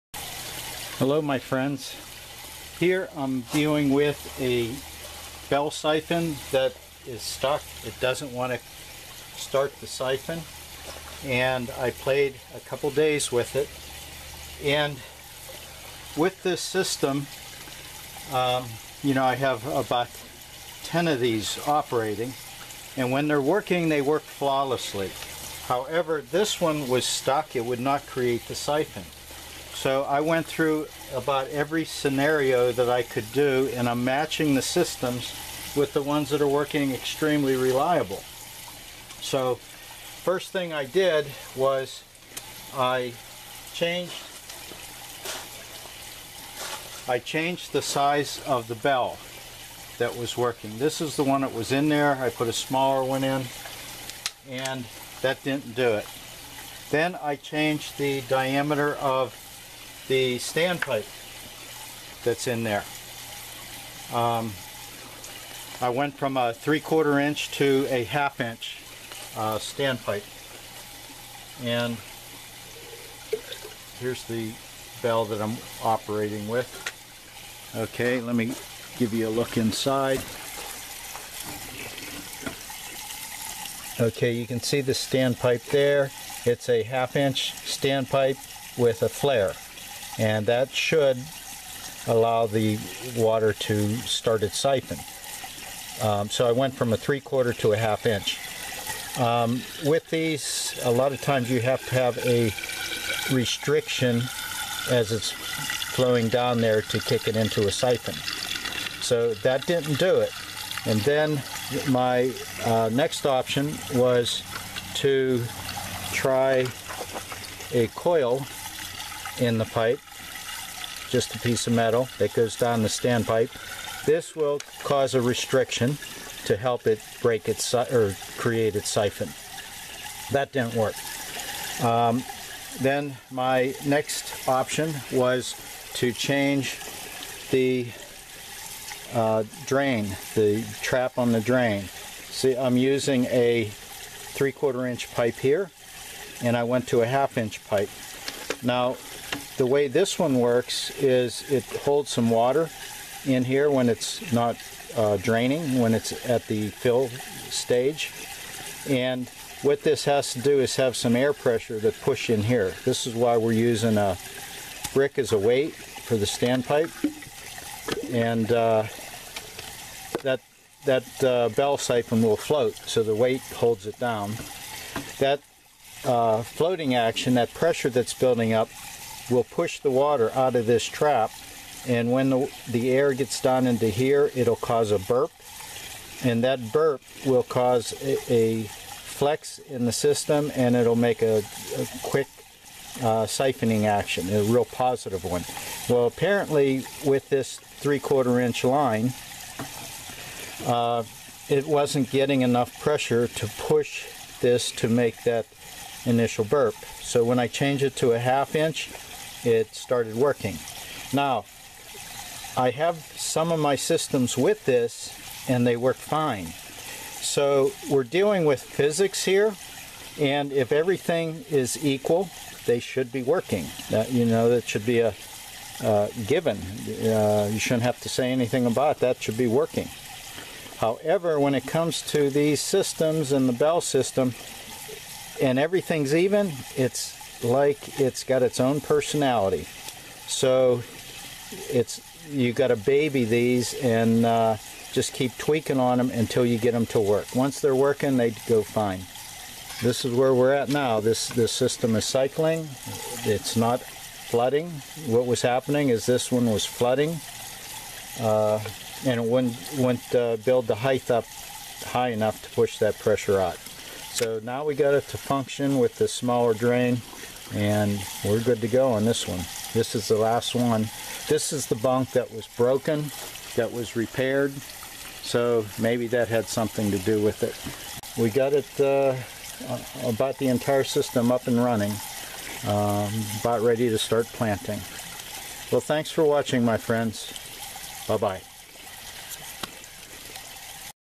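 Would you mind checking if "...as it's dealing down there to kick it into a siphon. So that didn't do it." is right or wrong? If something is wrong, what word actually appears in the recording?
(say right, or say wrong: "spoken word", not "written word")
wrong: "flowing", not "dealing".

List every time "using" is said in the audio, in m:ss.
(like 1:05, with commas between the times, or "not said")
2:22, 2:43.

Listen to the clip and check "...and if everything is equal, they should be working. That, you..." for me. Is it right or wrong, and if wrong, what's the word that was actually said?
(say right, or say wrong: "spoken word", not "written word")
right.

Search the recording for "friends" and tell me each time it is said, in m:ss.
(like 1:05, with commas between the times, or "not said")
0:01, 4:46.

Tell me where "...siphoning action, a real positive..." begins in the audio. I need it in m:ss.
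3:13.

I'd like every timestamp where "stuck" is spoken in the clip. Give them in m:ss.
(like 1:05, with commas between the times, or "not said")
0:07, 0:27.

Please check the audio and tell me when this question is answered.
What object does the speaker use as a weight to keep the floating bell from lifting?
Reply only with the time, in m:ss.
2:43.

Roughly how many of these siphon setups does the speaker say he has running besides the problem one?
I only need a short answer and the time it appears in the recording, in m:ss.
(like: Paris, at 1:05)
10, at 0:19.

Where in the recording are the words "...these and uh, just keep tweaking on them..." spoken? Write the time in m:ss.
4:03.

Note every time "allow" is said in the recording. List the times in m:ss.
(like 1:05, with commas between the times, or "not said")
1:32.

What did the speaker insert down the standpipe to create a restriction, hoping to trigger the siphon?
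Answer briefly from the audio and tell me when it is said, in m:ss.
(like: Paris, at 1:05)
a coil, at 1:57.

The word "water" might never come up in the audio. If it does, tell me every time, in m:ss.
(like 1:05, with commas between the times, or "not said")
1:33, 2:32, 2:59.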